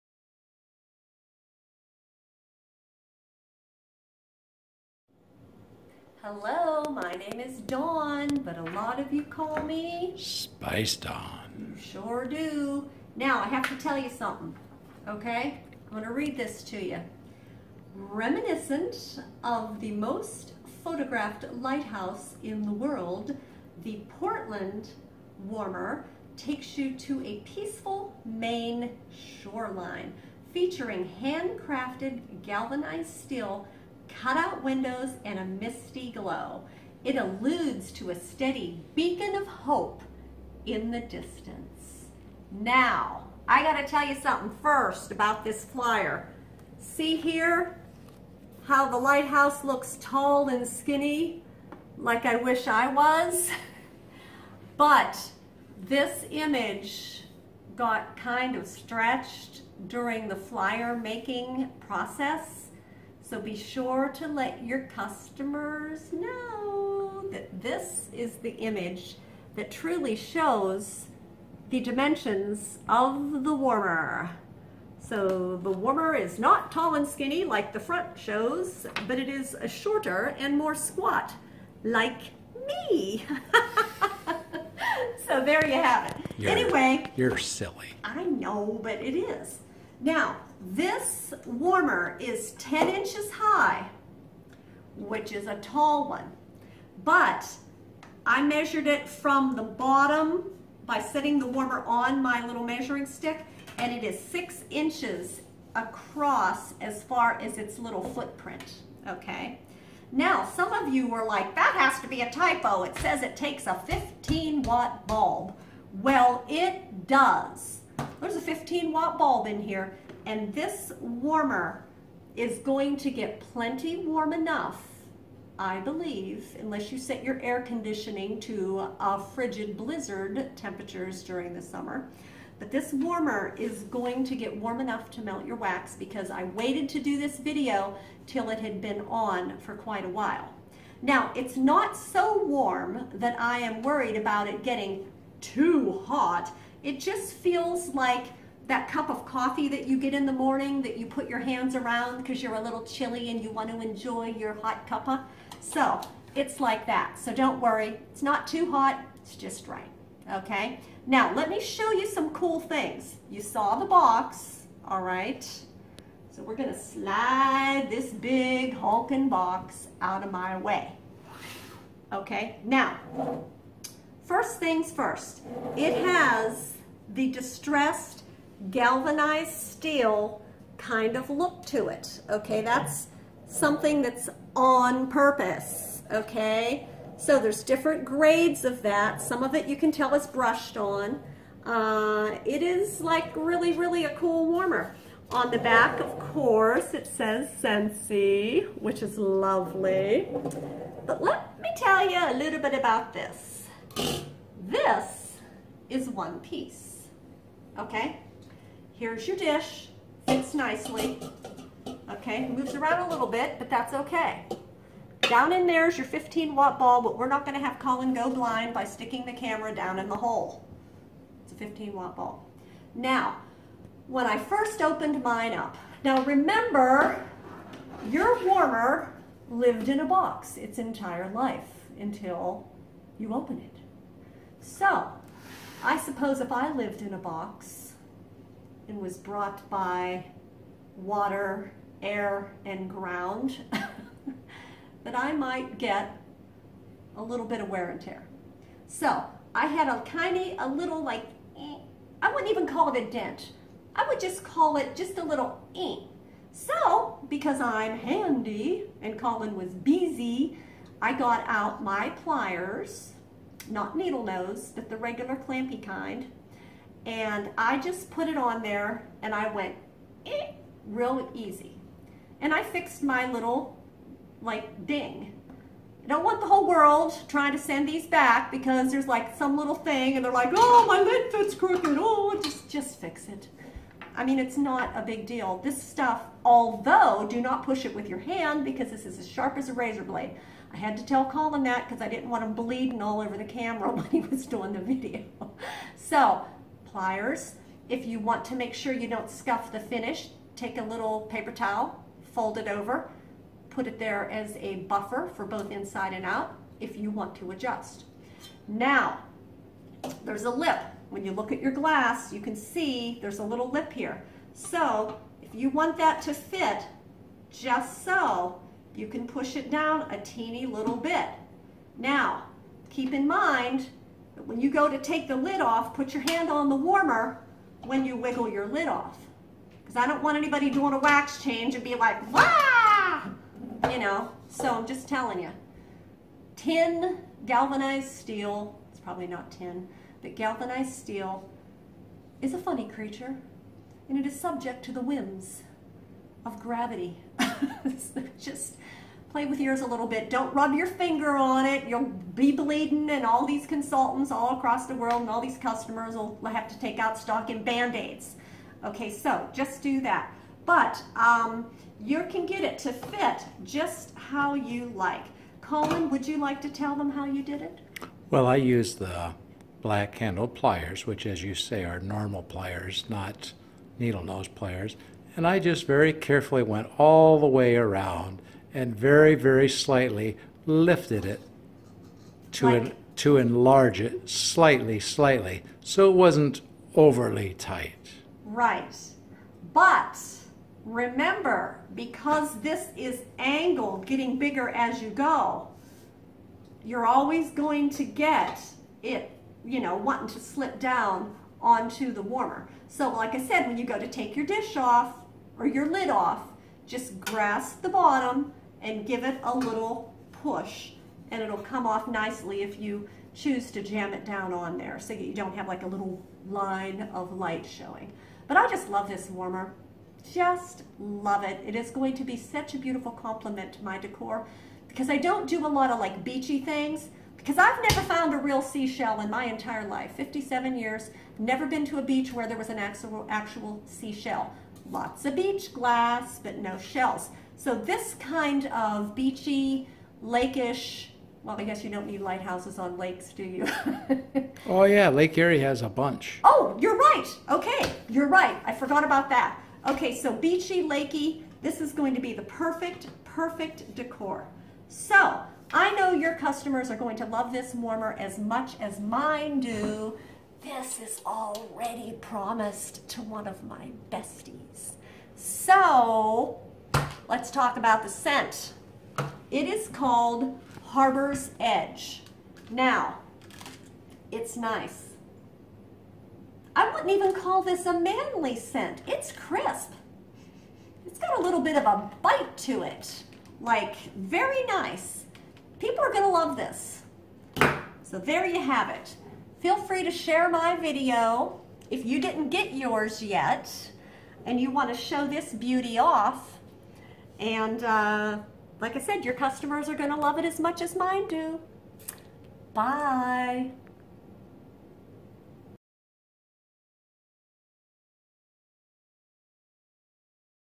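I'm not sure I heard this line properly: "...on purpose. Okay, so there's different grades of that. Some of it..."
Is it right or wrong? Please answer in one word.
right.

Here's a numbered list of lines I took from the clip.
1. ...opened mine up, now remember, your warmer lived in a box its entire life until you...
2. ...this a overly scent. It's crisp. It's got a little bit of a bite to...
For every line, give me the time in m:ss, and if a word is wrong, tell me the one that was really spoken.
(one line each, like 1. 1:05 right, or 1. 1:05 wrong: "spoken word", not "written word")
1. 3:44 right
2. 7:57 wrong: "manly", not "overly".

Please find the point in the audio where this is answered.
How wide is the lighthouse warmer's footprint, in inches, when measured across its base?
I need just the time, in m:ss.
1:44.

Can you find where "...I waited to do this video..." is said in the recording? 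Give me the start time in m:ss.
2:16.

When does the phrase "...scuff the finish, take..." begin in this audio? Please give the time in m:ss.
4:59.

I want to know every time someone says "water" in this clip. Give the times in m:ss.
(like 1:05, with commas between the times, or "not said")
4:00.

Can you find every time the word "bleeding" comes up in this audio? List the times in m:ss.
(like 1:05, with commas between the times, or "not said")
4:52, 5:52.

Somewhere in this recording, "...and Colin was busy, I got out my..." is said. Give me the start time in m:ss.
4:19.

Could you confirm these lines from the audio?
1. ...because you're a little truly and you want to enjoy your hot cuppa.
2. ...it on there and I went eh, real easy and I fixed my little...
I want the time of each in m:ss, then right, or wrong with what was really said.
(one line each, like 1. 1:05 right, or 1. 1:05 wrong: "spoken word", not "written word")
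1. 2:32 wrong: "chilly", not "truly"
2. 4:28 right.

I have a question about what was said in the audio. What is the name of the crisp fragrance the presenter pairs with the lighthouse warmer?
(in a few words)
Harbor's Edge.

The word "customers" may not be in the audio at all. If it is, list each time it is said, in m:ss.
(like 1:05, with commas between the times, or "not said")
1:04, 5:55, 7:36, 8:19.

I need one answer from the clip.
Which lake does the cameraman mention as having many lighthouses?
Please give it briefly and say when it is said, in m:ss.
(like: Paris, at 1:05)
Lake Erie, at 7:25.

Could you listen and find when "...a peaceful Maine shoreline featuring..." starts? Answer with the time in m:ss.
0:27.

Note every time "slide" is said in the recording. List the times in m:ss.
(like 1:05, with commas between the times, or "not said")
2:46.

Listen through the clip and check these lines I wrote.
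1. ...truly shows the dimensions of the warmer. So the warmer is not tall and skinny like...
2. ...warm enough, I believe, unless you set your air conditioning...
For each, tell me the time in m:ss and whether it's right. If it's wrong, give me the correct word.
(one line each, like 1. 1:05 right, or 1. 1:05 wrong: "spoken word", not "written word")
1. 1:09 right
2. 2:03 right.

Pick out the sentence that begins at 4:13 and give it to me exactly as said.
I would just call it just a little eh.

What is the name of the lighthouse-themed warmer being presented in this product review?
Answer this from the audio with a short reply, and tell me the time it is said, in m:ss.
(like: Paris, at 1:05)
Portland Warmer, at 0:24.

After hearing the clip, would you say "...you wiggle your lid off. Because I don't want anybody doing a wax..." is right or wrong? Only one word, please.
right.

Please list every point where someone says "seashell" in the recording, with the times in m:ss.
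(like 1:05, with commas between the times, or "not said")
7:08, 7:13.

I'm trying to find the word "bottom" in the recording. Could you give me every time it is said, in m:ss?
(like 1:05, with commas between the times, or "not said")
1:39, 6:47.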